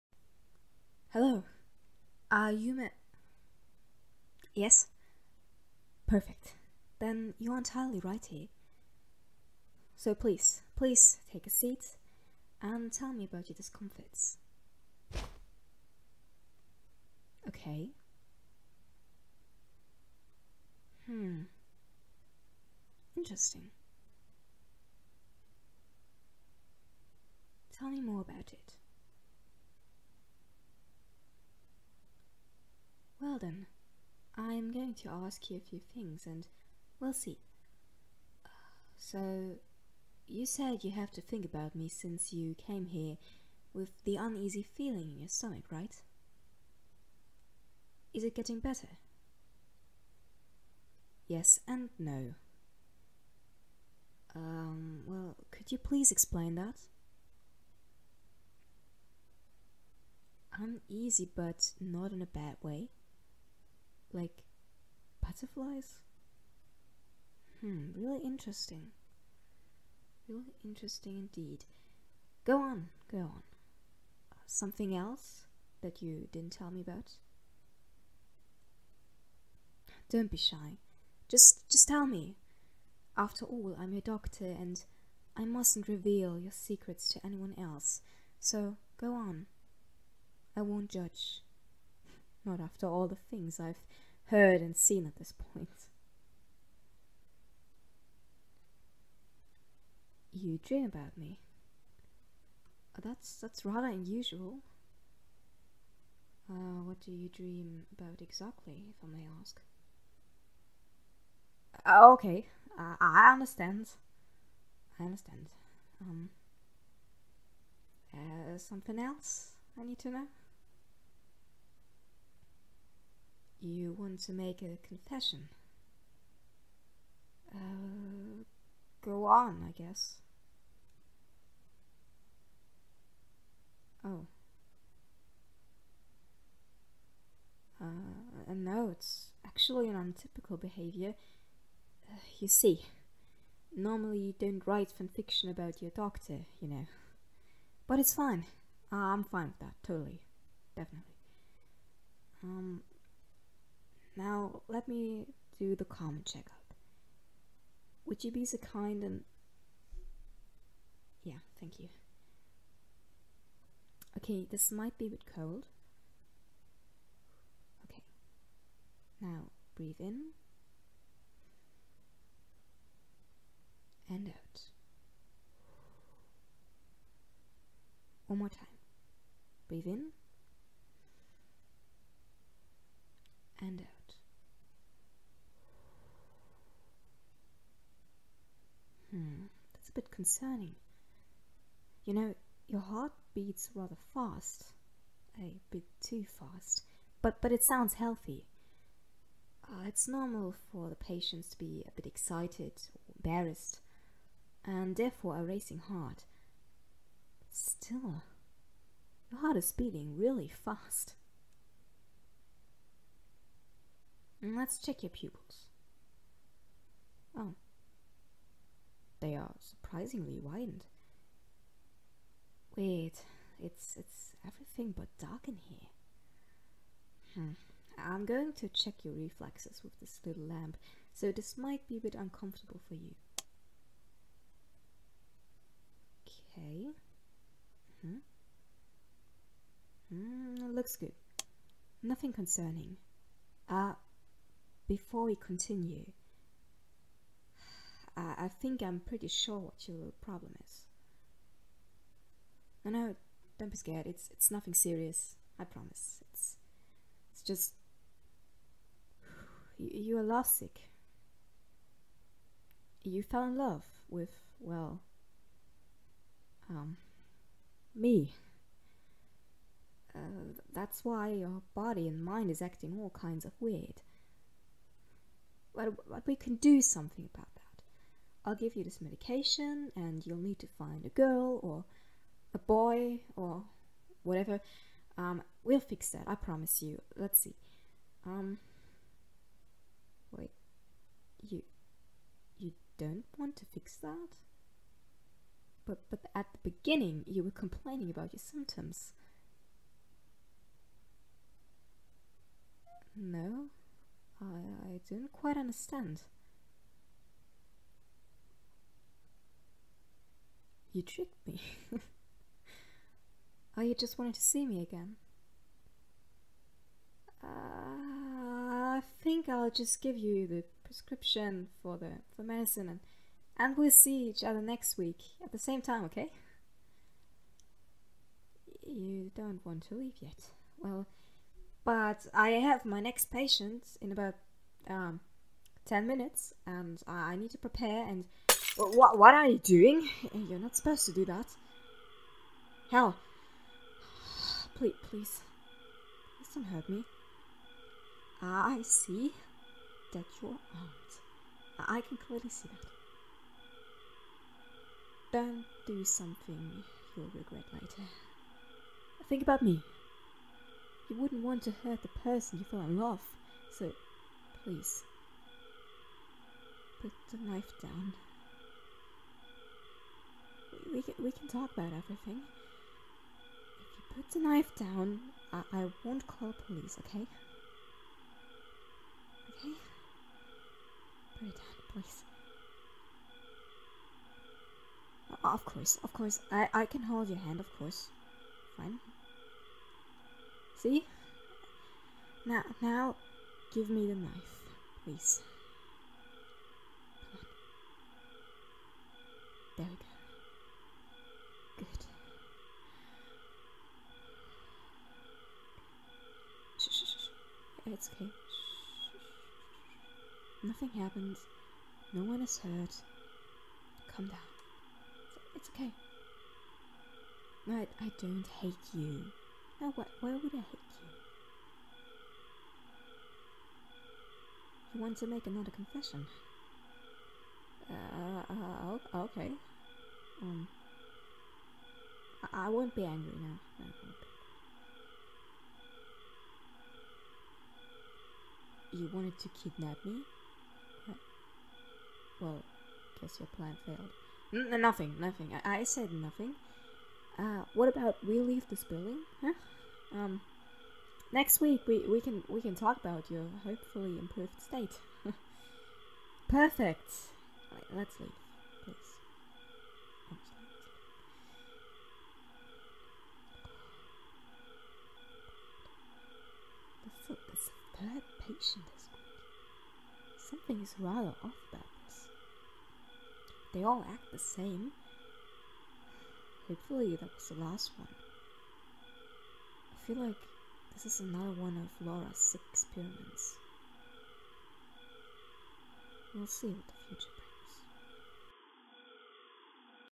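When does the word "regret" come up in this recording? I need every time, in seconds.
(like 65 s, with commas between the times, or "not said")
357 s.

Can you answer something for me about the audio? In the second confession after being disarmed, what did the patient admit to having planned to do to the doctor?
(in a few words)
Kidnap.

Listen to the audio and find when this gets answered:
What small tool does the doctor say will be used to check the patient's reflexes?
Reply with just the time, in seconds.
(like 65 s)
230 s.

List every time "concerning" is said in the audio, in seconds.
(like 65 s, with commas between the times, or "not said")
190 s, 242 s.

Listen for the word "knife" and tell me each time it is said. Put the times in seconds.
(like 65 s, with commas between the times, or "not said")
367 s, 374 s, 394 s.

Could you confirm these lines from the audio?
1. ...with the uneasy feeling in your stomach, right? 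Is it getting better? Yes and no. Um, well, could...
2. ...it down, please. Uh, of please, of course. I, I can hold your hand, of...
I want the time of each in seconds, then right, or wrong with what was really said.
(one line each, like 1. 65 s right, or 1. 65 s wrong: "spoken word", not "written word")
1. 43 s right
2. 381 s wrong: "course", not "please".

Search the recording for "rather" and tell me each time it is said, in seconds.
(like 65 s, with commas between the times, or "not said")
103 s, 193 s, 470 s.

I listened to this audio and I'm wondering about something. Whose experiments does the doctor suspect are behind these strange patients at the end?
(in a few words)
Laura's.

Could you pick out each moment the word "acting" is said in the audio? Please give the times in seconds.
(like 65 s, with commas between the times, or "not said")
272 s.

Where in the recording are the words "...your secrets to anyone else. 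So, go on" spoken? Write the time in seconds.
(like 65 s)
86 s.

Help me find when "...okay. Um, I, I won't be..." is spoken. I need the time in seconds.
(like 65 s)
429 s.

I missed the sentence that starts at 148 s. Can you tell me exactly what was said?
Uh, I'm fine with that, totally.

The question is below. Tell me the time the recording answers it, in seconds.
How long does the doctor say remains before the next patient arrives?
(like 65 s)
335 s.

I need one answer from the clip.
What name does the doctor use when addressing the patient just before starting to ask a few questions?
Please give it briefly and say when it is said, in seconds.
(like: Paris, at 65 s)
Sheldon, at 33 s.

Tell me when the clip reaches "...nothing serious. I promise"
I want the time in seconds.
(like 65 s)
254 s.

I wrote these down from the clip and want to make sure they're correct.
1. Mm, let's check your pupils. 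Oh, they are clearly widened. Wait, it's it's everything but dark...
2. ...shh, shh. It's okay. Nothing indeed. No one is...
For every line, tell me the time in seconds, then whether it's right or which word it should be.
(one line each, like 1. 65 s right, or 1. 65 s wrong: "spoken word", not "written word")
1. 214 s wrong: "surprisingly", not "clearly"
2. 406 s wrong: "happened", not "indeed".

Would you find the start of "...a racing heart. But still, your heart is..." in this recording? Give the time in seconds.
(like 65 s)
205 s.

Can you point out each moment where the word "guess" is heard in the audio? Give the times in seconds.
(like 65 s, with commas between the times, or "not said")
129 s, 443 s.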